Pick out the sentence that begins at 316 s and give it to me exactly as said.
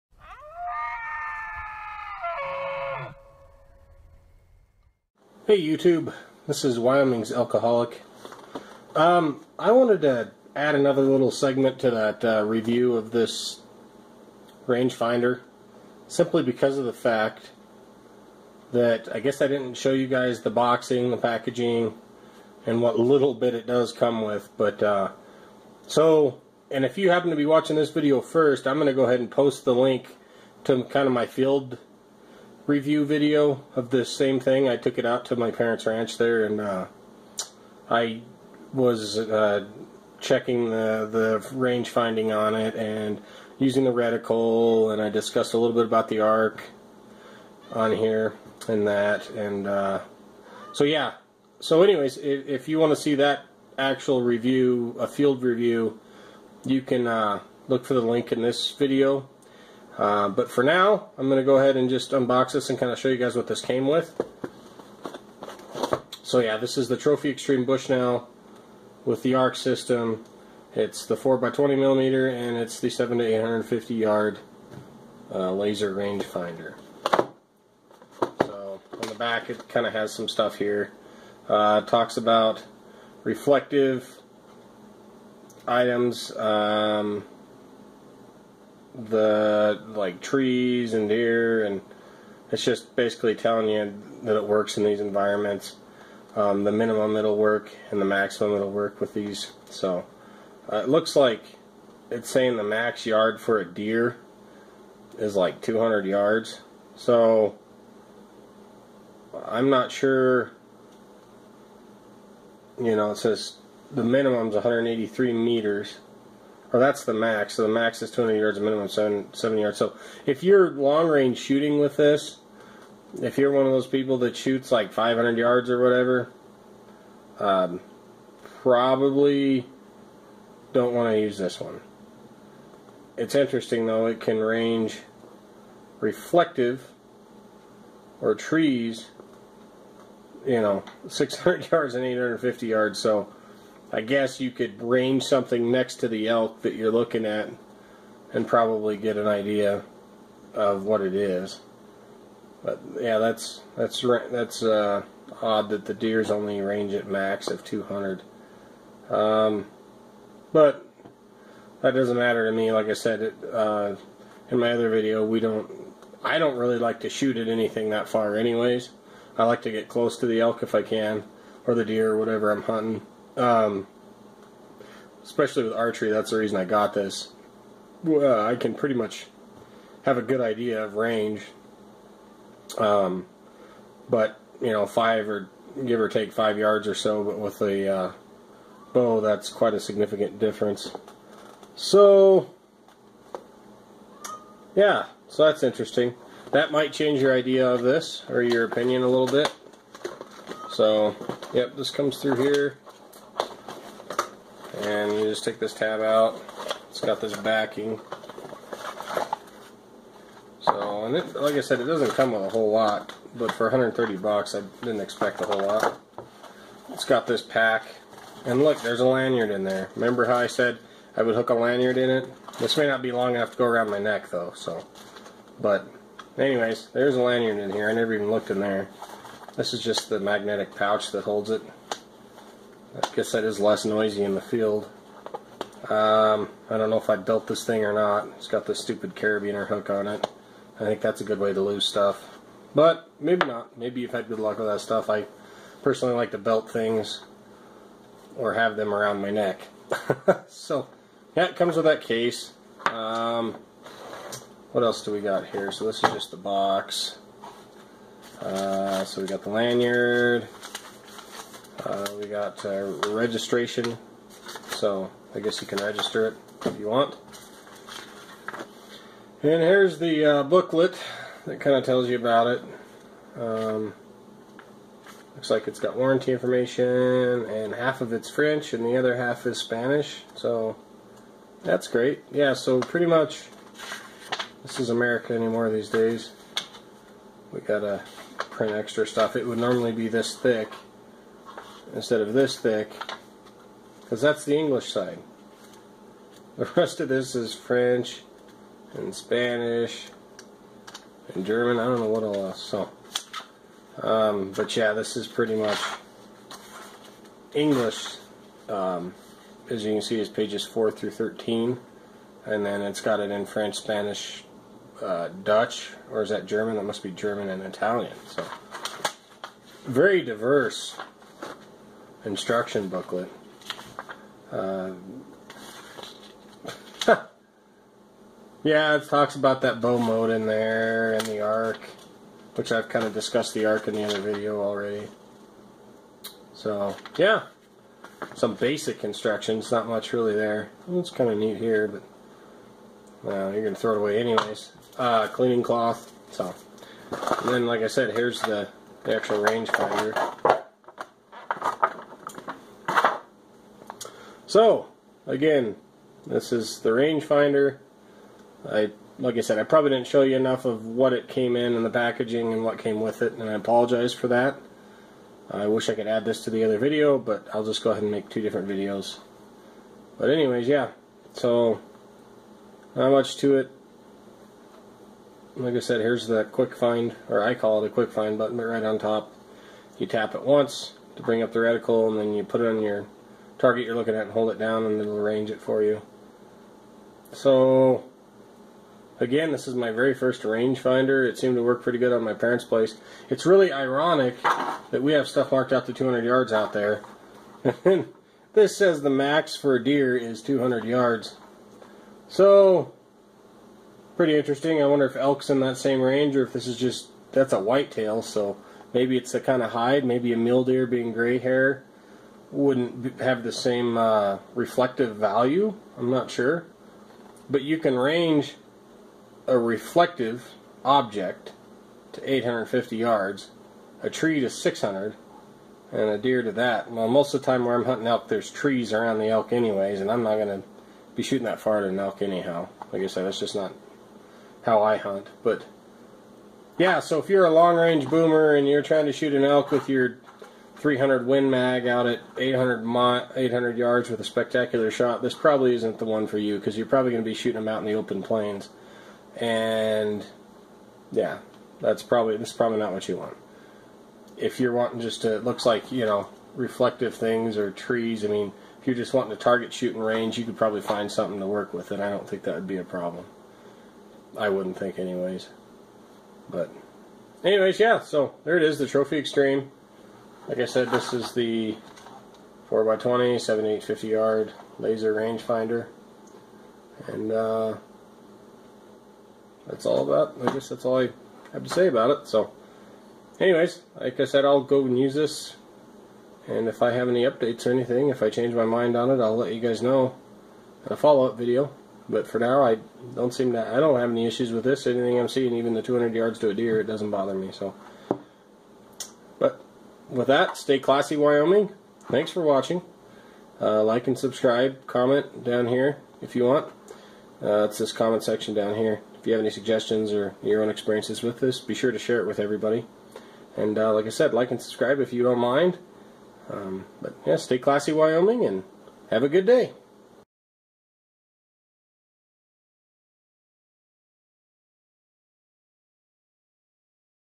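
That must be German and Italian.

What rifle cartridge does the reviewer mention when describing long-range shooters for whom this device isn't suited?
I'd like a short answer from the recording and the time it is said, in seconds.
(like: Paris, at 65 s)
300 Win Mag, at 440 s.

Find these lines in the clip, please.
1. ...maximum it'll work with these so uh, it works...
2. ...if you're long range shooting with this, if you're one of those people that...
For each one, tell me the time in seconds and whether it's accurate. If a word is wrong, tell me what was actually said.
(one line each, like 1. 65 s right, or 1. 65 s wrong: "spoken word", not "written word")
1. 98 s wrong: "looks", not "works"
2. 120 s right.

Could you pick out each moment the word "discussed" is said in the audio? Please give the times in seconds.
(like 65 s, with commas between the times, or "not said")
45 s, 333 s.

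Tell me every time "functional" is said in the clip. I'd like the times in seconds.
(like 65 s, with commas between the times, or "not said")
not said.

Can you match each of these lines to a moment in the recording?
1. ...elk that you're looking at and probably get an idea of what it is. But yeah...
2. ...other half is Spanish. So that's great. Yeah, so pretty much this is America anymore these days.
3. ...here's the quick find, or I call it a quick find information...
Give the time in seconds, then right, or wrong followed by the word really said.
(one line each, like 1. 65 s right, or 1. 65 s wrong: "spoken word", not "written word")
1. 146 s right
2. 278 s right
3. 376 s wrong: "button", not "information".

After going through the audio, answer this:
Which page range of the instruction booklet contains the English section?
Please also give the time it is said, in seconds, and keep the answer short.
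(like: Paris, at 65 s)
Pages 4 through 13, at 310 s.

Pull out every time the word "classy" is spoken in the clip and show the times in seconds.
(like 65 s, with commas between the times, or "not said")
500 s, 517 s.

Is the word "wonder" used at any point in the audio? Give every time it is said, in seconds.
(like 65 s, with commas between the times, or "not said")
404 s.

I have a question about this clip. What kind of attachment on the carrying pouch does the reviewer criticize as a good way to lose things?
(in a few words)
Carabiner hook.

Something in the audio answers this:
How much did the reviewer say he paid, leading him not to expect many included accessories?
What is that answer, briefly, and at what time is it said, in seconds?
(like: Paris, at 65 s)
$130, at 213 s.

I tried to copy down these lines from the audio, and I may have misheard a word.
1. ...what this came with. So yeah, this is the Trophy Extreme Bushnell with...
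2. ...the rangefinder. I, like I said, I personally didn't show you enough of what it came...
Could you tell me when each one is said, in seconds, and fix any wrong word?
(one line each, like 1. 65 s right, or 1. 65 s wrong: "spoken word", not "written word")
1. 63 s right
2. 356 s wrong: "probably", not "personally".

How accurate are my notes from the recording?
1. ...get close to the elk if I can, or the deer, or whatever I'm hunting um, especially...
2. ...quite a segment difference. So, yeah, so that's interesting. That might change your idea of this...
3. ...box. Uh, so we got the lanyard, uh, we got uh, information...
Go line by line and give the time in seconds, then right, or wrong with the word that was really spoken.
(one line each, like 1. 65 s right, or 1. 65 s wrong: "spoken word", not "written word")
1. 169 s right
2. 189 s wrong: "significant", not "segment"
3. 256 s wrong: "registration", not "information".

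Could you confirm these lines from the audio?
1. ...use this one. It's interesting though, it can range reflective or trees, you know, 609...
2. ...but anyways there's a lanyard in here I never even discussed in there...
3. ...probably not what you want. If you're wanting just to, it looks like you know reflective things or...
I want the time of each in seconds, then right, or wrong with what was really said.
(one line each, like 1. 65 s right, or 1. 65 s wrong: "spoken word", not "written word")
1. 131 s wrong: "600", not "609"
2. 225 s wrong: "looked", not "discussed"
3. 452 s right.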